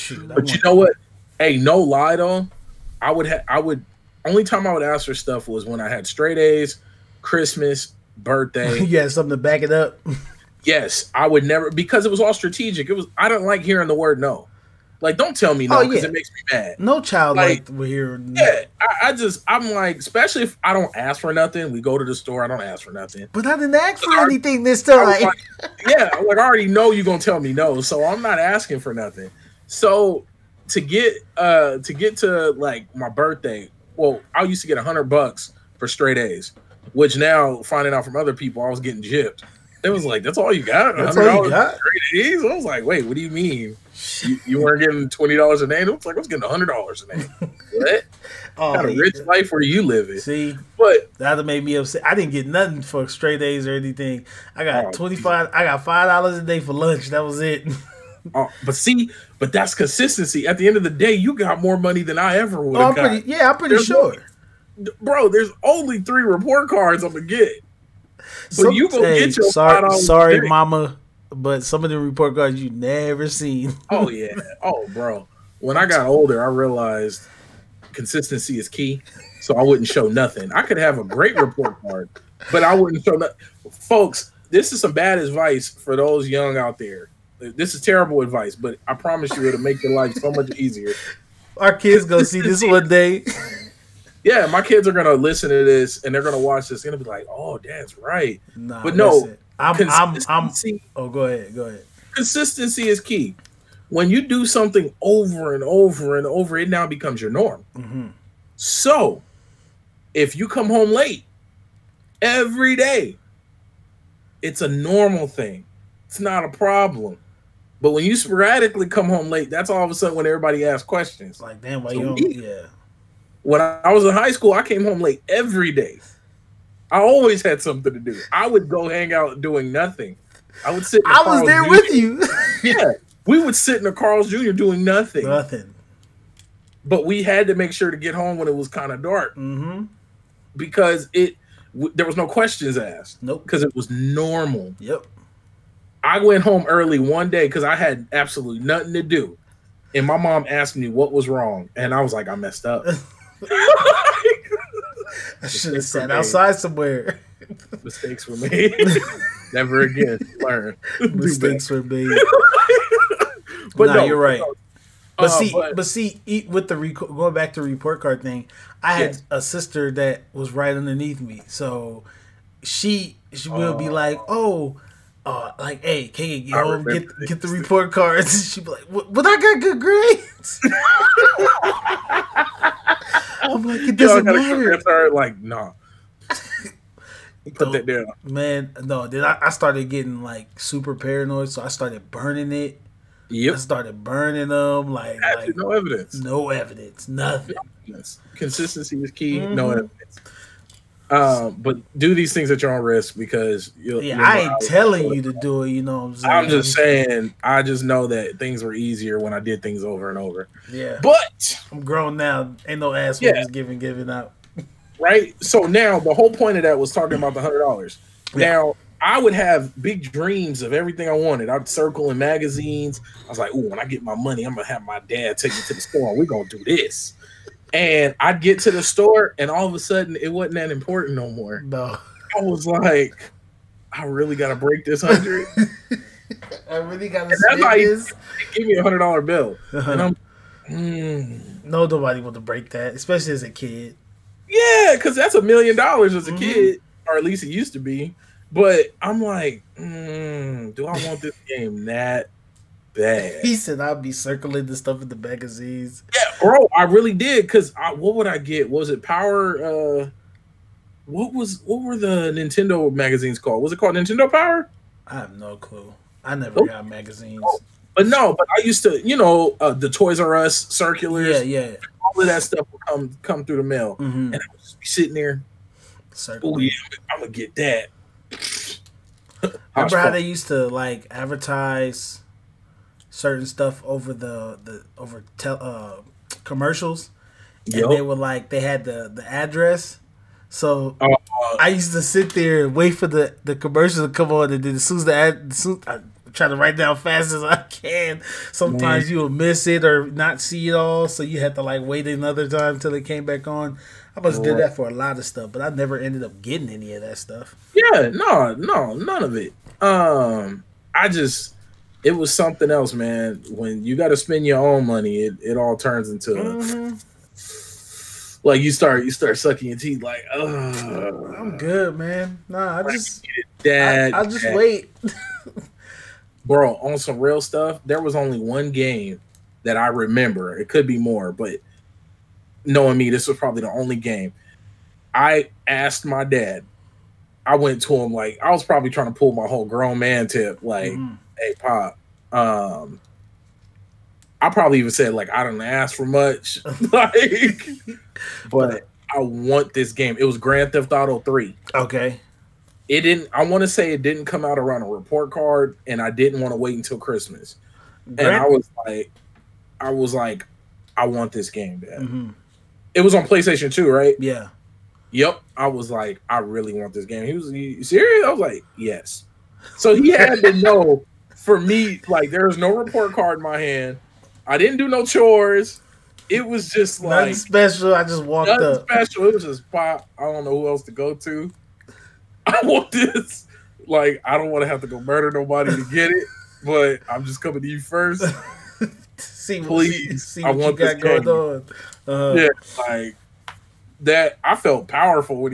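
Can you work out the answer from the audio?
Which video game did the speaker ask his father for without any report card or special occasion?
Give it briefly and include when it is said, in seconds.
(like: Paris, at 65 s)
Grand Theft Auto Three, at 350 s.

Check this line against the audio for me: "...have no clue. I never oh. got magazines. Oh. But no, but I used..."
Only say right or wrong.
right.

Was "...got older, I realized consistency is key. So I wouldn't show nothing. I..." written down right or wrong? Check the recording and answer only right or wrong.
right.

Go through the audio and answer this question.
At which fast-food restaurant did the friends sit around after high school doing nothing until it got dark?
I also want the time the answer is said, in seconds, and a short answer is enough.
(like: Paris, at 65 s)
Carl's Jr., at 133 s.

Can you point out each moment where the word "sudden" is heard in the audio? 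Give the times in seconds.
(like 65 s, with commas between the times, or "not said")
119 s, 229 s.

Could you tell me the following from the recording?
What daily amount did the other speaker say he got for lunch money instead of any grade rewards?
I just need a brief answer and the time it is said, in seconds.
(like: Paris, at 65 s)
$5, at 55 s.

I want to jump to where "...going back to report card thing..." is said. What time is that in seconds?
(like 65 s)
166 s.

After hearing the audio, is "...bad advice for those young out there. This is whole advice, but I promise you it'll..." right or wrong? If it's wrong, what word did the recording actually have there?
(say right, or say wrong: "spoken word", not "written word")
wrong: "terrible", not "whole".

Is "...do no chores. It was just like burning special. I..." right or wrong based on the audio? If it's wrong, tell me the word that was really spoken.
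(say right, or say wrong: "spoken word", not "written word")
wrong: "nothing", not "burning".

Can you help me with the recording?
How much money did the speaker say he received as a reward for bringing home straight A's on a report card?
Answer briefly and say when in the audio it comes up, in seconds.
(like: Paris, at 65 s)
$100, at 34 s.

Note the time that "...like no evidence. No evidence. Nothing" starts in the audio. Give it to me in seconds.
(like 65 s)
195 s.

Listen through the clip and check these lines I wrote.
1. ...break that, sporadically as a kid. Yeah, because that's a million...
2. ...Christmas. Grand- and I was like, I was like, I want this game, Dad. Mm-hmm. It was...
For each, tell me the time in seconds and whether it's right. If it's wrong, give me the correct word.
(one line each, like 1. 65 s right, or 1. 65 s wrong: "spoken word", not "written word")
1. 242 s wrong: "especially", not "sporadically"
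2. 356 s right.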